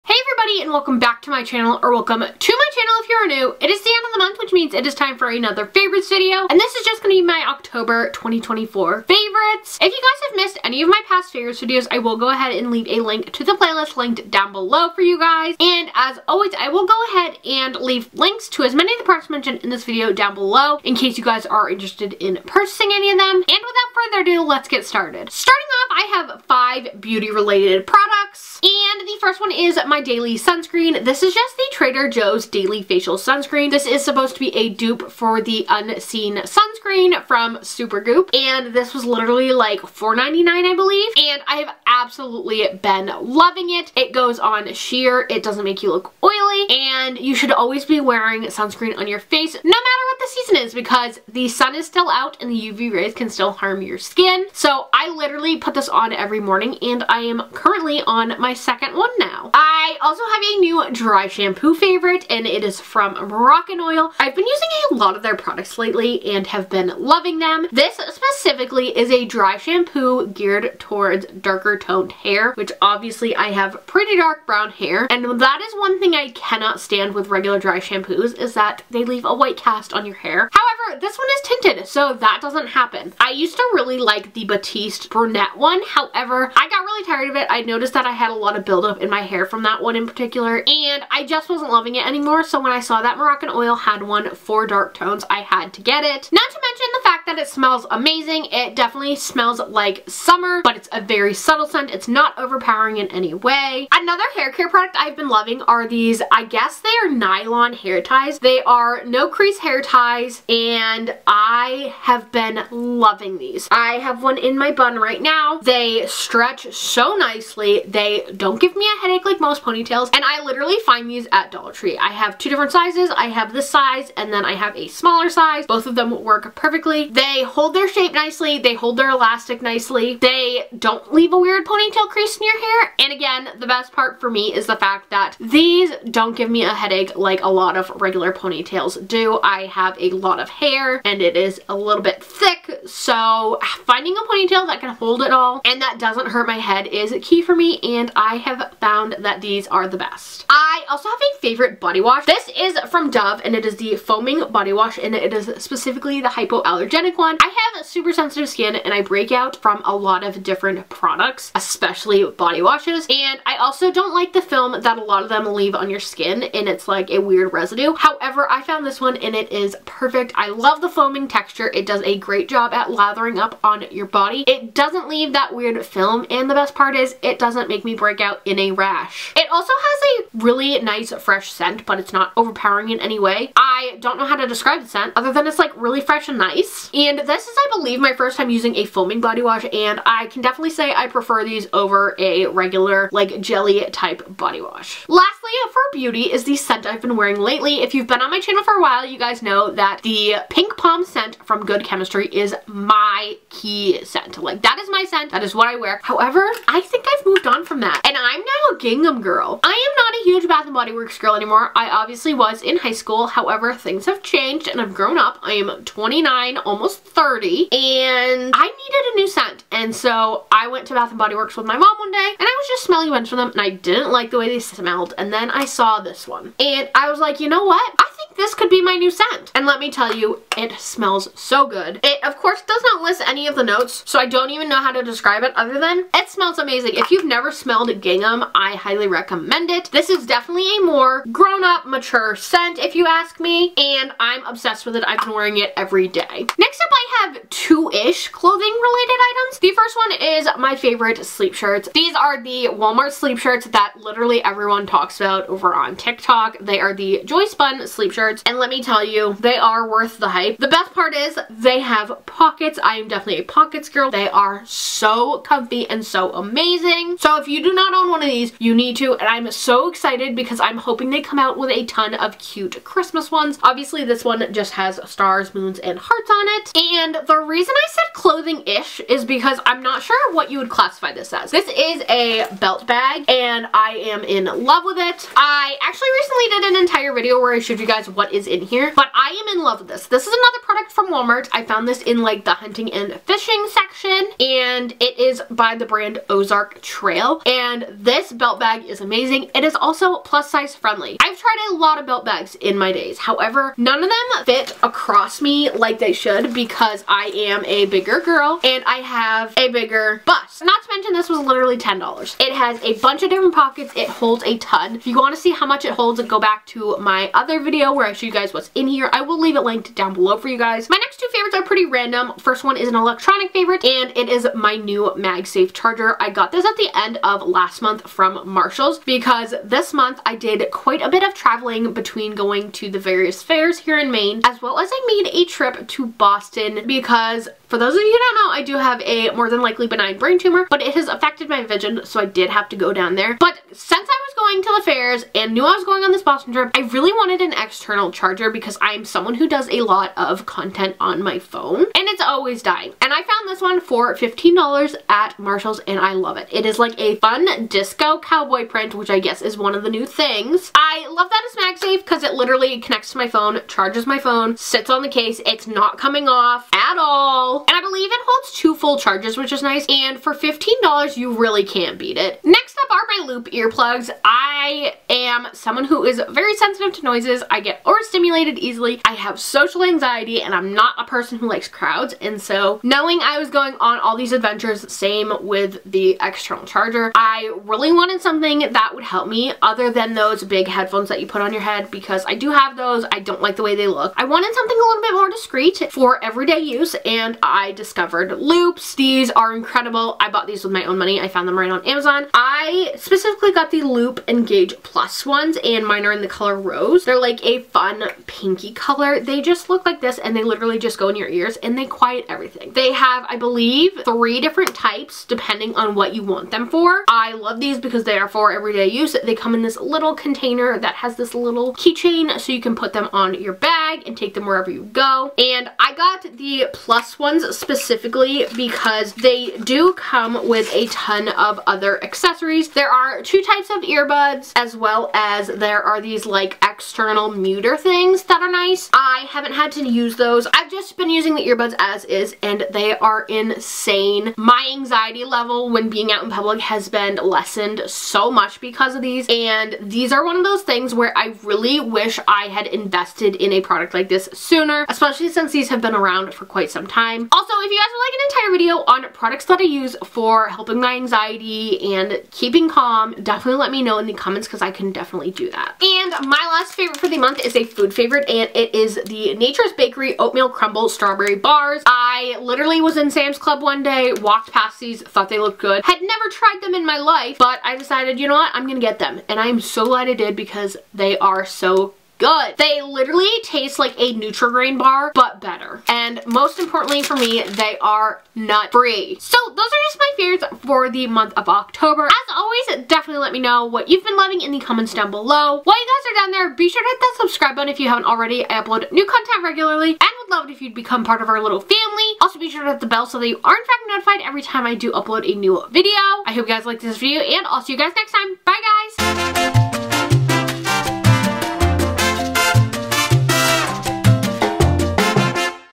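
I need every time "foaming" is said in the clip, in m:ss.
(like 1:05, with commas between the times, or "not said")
2:33, 2:50, 3:08.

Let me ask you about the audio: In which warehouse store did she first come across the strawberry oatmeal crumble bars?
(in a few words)
Sam's Club.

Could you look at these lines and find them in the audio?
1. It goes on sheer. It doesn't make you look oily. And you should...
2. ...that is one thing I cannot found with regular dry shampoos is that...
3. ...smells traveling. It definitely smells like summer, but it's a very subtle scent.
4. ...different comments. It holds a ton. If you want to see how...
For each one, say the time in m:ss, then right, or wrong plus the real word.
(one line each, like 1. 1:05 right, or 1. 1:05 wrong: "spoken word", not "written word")
1. 0:43 right
2. 1:15 wrong: "stand", not "found"
3. 1:37 wrong: "amazing", not "traveling"
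4. 5:13 wrong: "pockets", not "comments".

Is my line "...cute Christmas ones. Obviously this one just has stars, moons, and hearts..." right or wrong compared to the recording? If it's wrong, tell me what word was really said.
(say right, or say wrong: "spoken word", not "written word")
right.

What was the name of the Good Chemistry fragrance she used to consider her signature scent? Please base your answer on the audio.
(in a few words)
Pink Palm.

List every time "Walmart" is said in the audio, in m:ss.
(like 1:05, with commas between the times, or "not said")
4:12, 4:51.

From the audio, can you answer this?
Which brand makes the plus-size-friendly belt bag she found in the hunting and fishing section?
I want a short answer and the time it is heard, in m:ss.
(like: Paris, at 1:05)
Ozark Trail, at 4:56.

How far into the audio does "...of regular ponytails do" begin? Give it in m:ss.
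2:17.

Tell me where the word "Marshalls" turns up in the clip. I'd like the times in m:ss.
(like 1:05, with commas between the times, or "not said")
5:28, 5:55.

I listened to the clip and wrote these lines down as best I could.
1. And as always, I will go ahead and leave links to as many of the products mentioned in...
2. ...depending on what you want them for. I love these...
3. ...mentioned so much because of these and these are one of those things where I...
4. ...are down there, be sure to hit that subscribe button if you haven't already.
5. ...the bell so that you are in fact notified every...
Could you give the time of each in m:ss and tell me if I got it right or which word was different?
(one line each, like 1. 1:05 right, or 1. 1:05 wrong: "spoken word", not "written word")
1. 0:15 right
2. 6:55 right
3. 7:27 wrong: "lessened", not "mentioned"
4. 8:16 right
5. 8:22 right.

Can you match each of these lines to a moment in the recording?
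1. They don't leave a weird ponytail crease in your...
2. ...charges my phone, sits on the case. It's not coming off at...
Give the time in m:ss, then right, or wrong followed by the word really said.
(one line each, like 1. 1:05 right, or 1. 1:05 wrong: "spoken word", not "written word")
1. 2:10 right
2. 6:03 right.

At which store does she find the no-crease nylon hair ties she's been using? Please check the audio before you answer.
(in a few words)
Dollar Tree.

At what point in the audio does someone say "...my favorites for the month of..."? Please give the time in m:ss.
8:09.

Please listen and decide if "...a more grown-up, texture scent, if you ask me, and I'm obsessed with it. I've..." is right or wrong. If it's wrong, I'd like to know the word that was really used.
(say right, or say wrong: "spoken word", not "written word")
wrong: "mature", not "texture".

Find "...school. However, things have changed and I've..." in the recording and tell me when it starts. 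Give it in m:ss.
3:32.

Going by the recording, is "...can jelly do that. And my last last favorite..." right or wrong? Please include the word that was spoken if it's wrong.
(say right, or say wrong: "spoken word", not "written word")
wrong: "definitely", not "jelly".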